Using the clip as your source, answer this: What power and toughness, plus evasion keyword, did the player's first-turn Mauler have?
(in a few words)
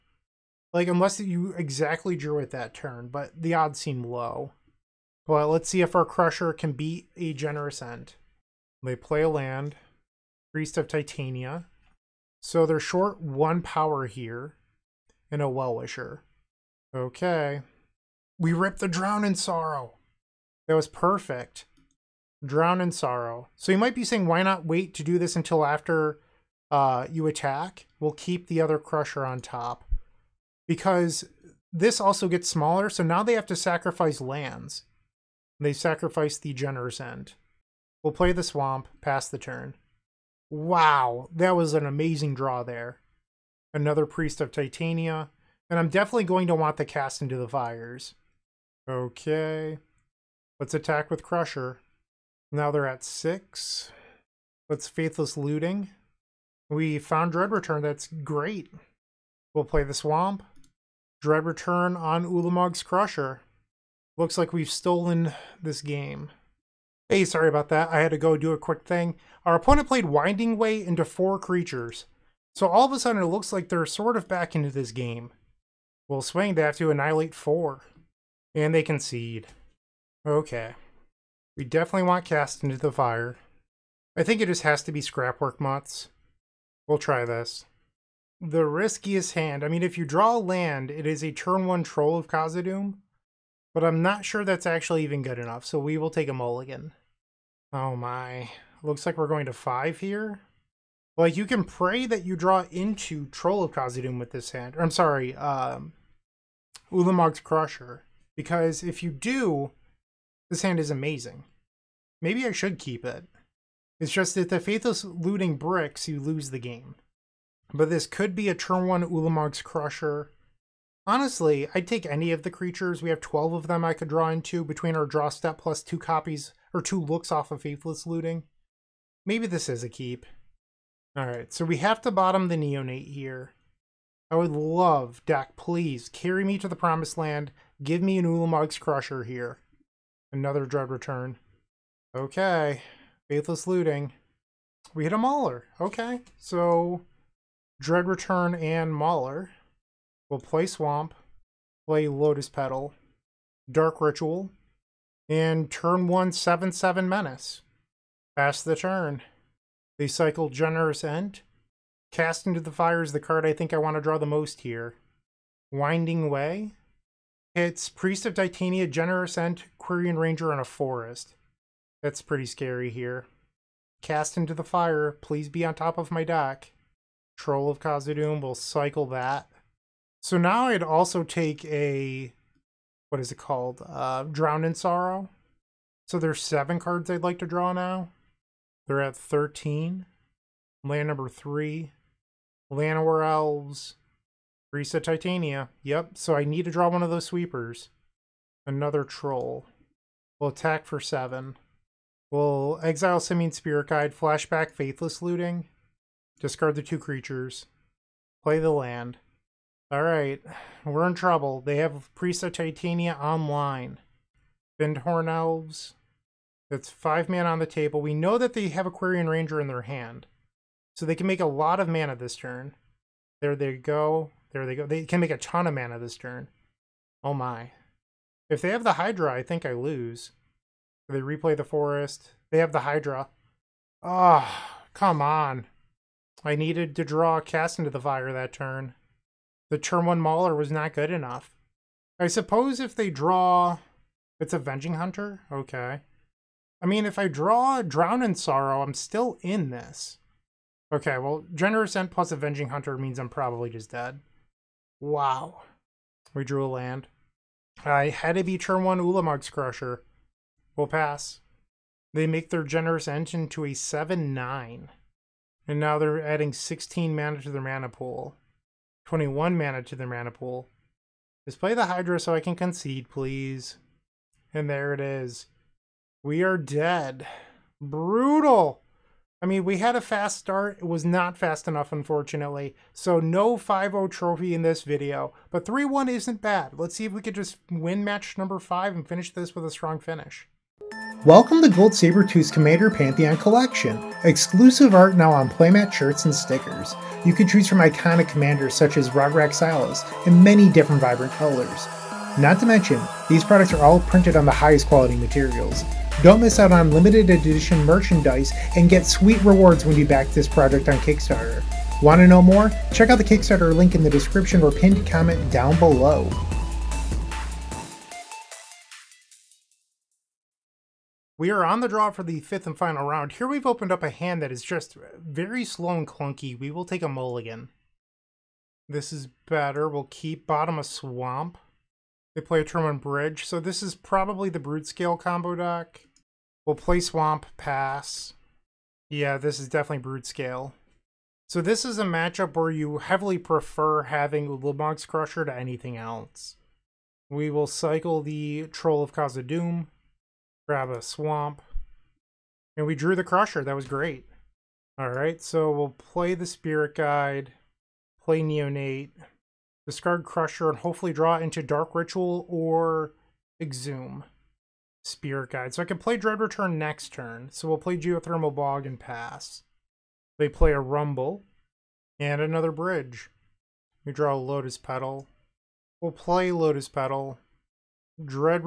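7/7 Menace.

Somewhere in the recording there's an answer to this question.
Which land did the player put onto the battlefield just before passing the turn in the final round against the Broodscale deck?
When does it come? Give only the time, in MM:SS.
06:07.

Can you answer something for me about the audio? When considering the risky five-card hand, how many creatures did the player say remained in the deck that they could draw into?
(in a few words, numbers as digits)
12.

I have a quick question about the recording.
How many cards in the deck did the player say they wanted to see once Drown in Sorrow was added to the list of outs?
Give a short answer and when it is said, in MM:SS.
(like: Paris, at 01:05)
7, at 03:06.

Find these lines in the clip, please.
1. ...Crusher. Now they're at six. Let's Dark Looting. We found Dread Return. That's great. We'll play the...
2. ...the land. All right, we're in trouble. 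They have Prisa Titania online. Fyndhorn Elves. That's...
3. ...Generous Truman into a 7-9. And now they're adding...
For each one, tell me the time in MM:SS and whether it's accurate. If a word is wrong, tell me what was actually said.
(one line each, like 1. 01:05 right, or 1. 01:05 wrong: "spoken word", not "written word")
1. 00:51 wrong: "Faithless", not "Dark"
2. 03:28 right
3. 04:22 wrong: "Ent", not "Truman".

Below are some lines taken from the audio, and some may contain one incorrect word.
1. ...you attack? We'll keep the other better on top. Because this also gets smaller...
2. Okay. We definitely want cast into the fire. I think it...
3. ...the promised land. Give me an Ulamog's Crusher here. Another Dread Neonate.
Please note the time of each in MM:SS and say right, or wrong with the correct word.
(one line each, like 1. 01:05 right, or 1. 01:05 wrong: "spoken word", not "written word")
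1. 00:27 wrong: "crusher", not "better"
2. 01:20 right
3. 02:16 wrong: "Return", not "Neonate".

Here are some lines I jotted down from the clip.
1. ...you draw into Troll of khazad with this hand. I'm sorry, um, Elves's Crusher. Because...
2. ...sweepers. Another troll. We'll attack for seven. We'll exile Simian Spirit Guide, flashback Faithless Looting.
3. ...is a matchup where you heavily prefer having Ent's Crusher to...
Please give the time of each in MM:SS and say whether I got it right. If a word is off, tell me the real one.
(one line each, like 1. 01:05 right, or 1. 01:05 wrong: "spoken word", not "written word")
1. 01:42 wrong: "Ulamog", not "Elves"
2. 03:17 right
3. 05:41 wrong: "Ulamog", not "Ent".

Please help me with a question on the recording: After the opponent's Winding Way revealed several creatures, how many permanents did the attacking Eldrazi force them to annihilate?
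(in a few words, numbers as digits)
4.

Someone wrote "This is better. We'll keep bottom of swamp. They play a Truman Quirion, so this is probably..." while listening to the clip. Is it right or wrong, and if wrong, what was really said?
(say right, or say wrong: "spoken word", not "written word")
wrong: "Bridge", not "Quirion".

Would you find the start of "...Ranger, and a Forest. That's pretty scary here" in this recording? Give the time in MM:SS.
02:50.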